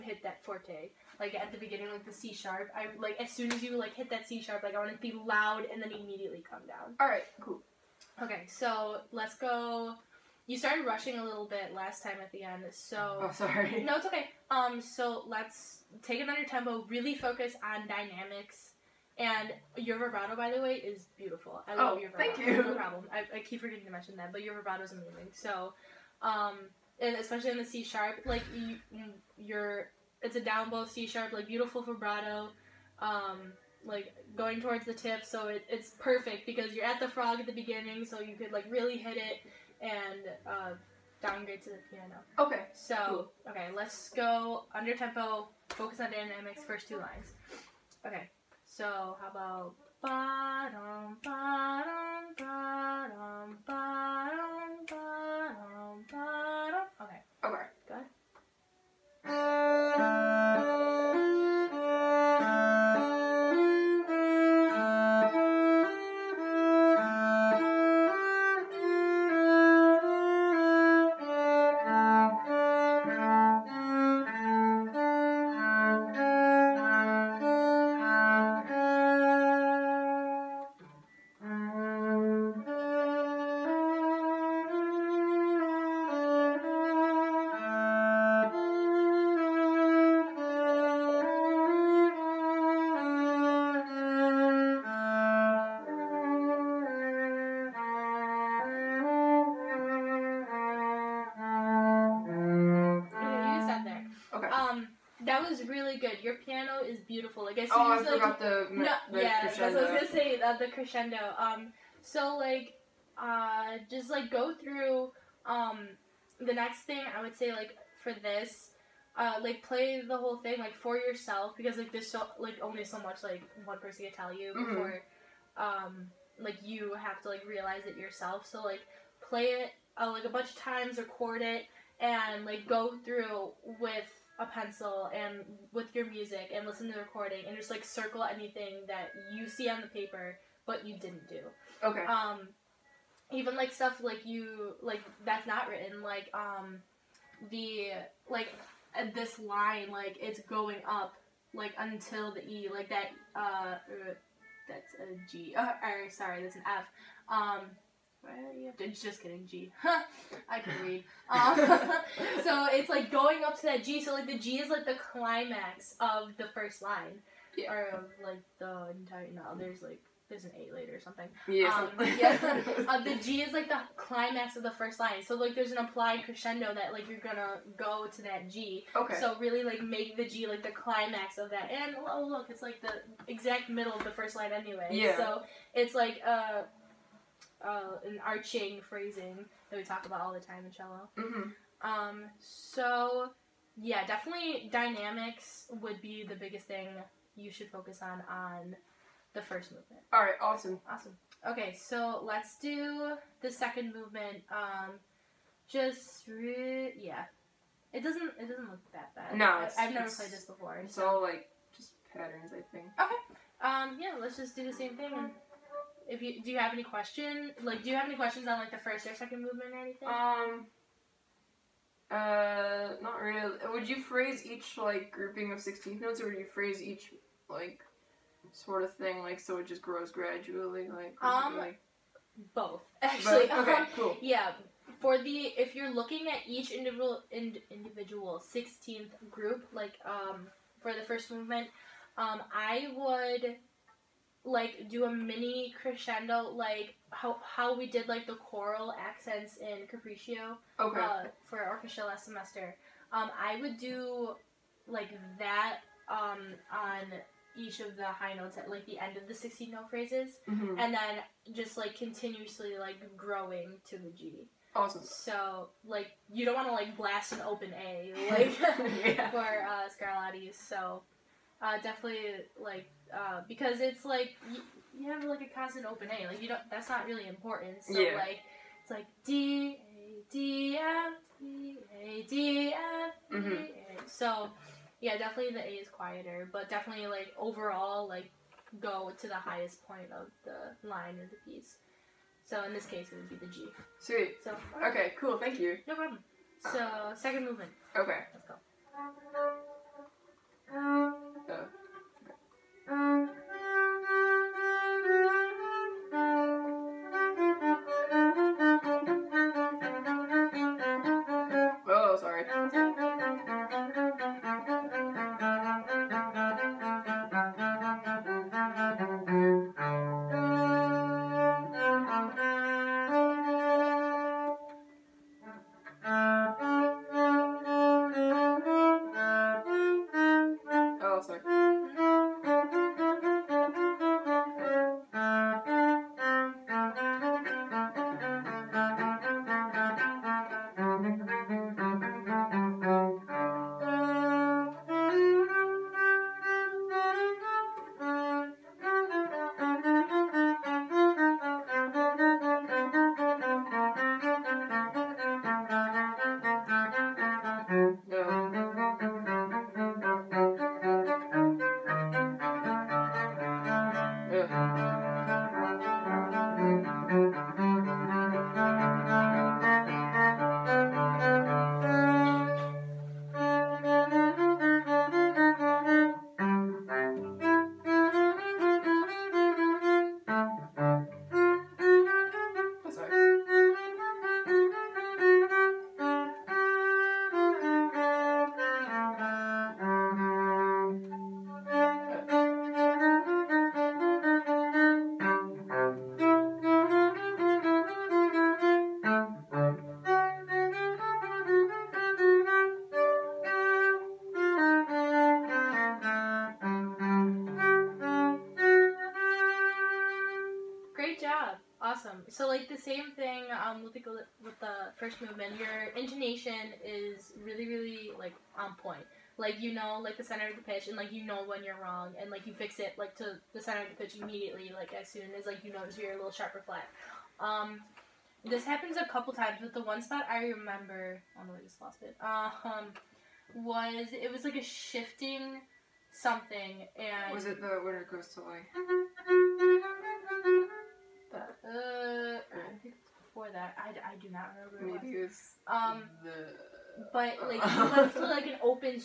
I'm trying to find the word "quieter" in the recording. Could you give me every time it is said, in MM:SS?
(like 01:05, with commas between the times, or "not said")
04:45.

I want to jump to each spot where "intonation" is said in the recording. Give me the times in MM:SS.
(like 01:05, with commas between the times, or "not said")
06:55.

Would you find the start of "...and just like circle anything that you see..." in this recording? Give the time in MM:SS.
02:17.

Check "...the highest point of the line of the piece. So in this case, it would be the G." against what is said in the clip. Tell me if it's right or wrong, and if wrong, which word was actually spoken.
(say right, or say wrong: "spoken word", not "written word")
right.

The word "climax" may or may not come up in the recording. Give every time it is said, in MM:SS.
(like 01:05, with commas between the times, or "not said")
02:45, 02:53, 03:00.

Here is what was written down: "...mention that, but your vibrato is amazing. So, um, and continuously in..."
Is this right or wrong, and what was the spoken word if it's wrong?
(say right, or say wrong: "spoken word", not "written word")
wrong: "especially", not "continuously".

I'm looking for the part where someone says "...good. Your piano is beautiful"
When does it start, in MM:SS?
01:45.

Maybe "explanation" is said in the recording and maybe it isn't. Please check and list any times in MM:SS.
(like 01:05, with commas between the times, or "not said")
not said.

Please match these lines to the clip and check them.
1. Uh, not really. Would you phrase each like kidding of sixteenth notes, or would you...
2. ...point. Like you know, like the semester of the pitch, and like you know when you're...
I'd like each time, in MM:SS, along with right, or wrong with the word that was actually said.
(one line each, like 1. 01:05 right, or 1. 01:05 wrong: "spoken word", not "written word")
1. 03:42 wrong: "grouping", not "kidding"
2. 06:58 wrong: "center", not "semester".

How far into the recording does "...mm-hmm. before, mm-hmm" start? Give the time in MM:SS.
02:04.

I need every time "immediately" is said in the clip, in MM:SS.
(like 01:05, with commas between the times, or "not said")
00:05, 07:04.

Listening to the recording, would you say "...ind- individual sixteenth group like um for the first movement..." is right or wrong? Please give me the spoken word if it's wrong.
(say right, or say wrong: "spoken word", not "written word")
right.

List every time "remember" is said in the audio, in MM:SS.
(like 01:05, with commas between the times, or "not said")
07:10, 07:24.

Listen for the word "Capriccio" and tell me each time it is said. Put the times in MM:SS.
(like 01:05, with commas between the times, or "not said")
04:09.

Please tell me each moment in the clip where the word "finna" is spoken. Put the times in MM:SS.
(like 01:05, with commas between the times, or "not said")
not said.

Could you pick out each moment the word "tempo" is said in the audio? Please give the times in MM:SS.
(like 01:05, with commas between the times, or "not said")
00:16, 00:44.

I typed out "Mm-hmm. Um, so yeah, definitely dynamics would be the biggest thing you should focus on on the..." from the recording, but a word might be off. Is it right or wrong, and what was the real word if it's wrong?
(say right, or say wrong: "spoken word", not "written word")
right.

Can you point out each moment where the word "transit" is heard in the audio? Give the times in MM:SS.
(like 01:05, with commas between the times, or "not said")
not said.